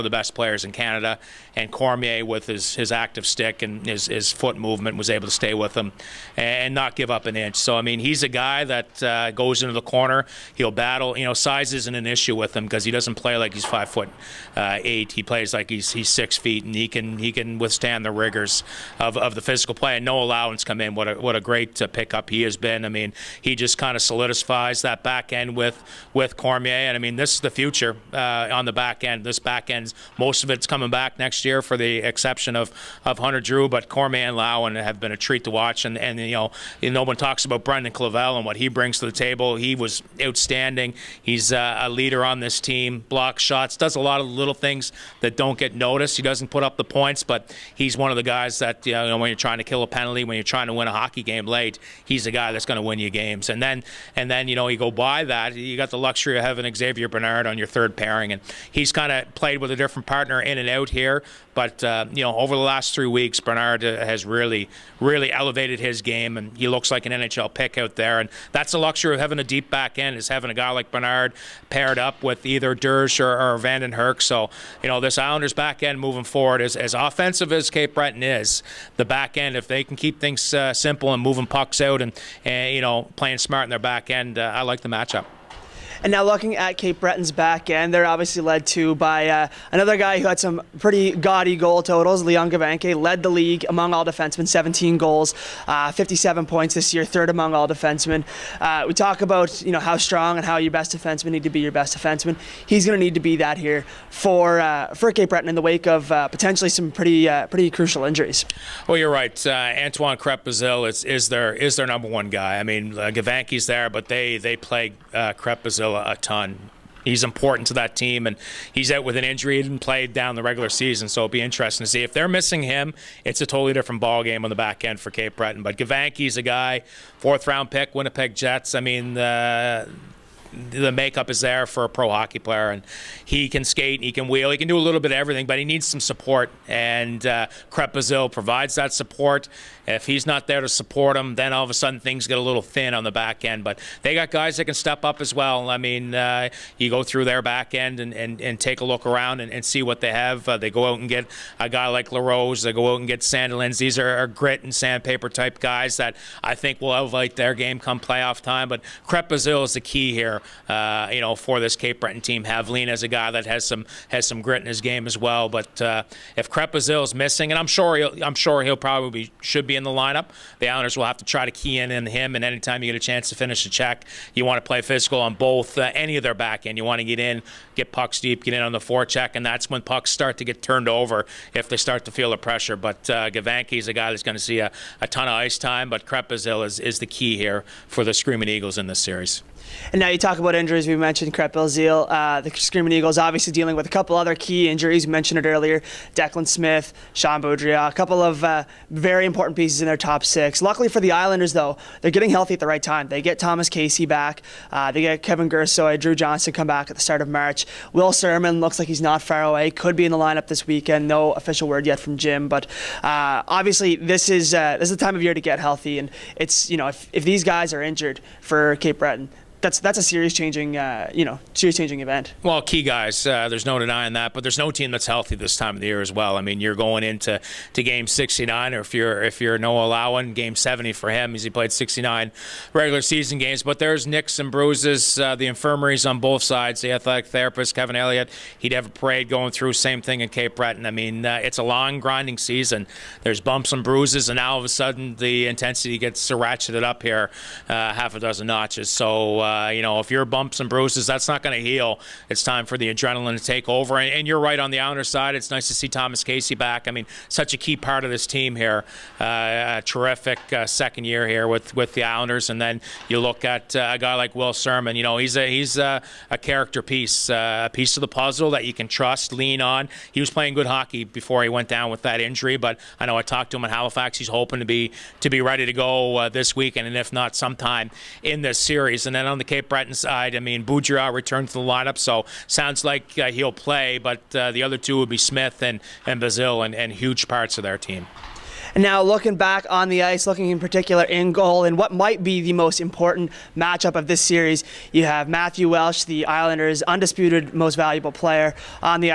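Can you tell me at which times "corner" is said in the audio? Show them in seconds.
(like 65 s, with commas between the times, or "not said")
9 s.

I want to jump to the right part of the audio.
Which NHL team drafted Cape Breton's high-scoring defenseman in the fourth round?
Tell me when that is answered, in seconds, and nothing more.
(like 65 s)
127 s.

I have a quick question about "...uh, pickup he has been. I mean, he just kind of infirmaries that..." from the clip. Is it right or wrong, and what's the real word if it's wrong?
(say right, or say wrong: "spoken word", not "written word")
wrong: "solidifies", not "infirmaries".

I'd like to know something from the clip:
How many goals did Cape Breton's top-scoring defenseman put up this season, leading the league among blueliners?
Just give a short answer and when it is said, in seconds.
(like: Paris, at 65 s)
17, at 94 s.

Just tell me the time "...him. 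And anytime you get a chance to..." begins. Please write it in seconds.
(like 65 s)
172 s.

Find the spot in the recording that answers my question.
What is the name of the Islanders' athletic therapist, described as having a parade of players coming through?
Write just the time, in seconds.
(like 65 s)
237 s.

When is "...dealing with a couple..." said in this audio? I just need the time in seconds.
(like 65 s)
193 s.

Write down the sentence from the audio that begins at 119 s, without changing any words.
He didn't play down the regular season, so it'll be interesting to see.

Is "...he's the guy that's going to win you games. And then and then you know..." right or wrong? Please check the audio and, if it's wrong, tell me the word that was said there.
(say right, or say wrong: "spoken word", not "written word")
right.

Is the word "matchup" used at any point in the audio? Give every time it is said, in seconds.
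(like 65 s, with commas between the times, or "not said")
84 s, 293 s.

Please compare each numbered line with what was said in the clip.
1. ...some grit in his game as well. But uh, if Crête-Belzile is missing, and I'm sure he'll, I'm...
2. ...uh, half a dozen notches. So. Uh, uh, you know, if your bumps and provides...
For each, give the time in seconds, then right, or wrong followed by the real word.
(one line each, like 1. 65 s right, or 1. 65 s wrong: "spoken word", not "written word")
1. 164 s right
2. 247 s wrong: "bruises", not "provides".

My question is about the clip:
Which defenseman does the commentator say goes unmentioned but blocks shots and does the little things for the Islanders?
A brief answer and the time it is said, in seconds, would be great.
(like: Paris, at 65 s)
Brendan Clavel, at 37 s.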